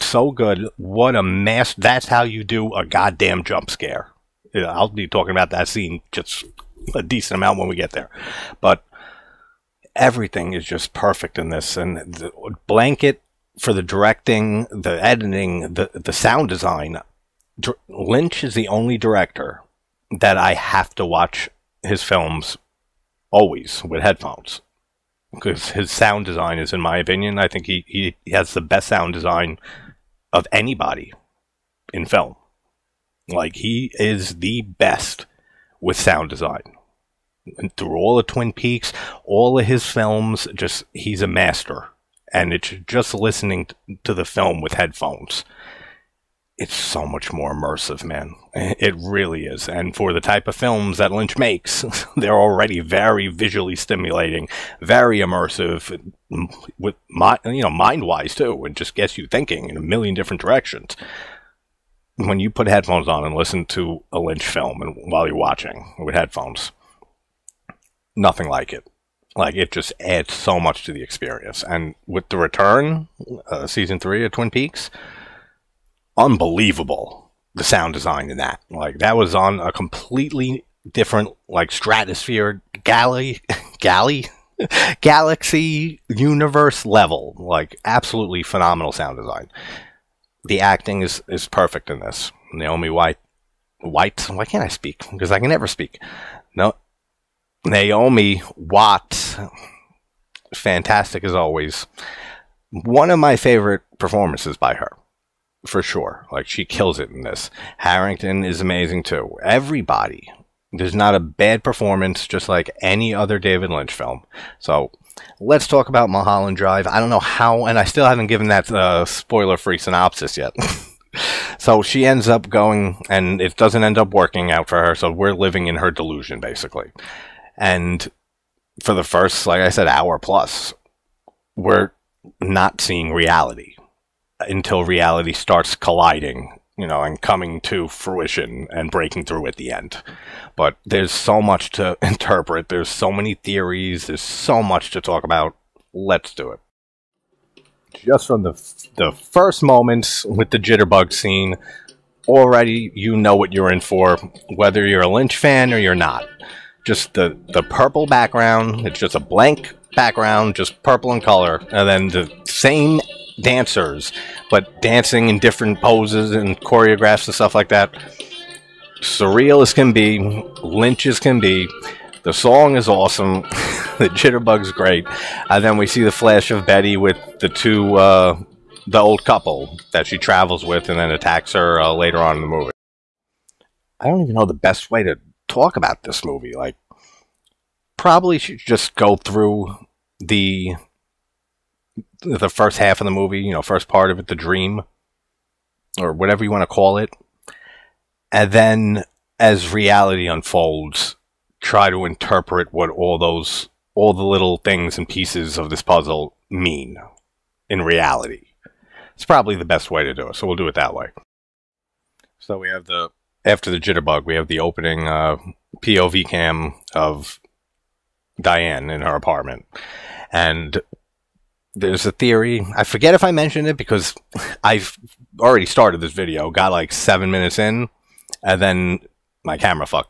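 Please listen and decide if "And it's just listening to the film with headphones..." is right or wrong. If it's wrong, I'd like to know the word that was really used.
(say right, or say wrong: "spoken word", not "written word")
right.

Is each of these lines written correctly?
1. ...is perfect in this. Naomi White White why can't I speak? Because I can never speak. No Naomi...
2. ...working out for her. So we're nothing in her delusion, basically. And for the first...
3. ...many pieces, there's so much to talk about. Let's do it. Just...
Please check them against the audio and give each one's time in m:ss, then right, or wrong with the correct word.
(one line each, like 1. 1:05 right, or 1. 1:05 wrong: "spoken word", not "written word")
1. 1:31 right
2. 2:04 wrong: "living", not "nothing"
3. 2:23 wrong: "theories", not "pieces".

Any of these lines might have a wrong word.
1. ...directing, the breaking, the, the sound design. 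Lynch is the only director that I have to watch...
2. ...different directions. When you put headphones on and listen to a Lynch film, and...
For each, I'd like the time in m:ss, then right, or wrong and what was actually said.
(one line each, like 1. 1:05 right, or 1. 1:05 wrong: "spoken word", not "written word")
1. 0:13 wrong: "editing", not "breaking"
2. 1:00 right.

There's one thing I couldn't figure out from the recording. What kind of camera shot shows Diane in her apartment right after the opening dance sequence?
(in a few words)
POV cam.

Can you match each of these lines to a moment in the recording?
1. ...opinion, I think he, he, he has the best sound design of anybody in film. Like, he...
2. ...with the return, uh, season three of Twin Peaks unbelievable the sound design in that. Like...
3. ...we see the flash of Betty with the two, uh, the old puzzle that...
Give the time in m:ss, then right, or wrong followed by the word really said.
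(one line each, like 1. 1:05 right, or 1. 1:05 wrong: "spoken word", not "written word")
1. 0:26 right
2. 1:12 right
3. 2:55 wrong: "couple", not "puzzle".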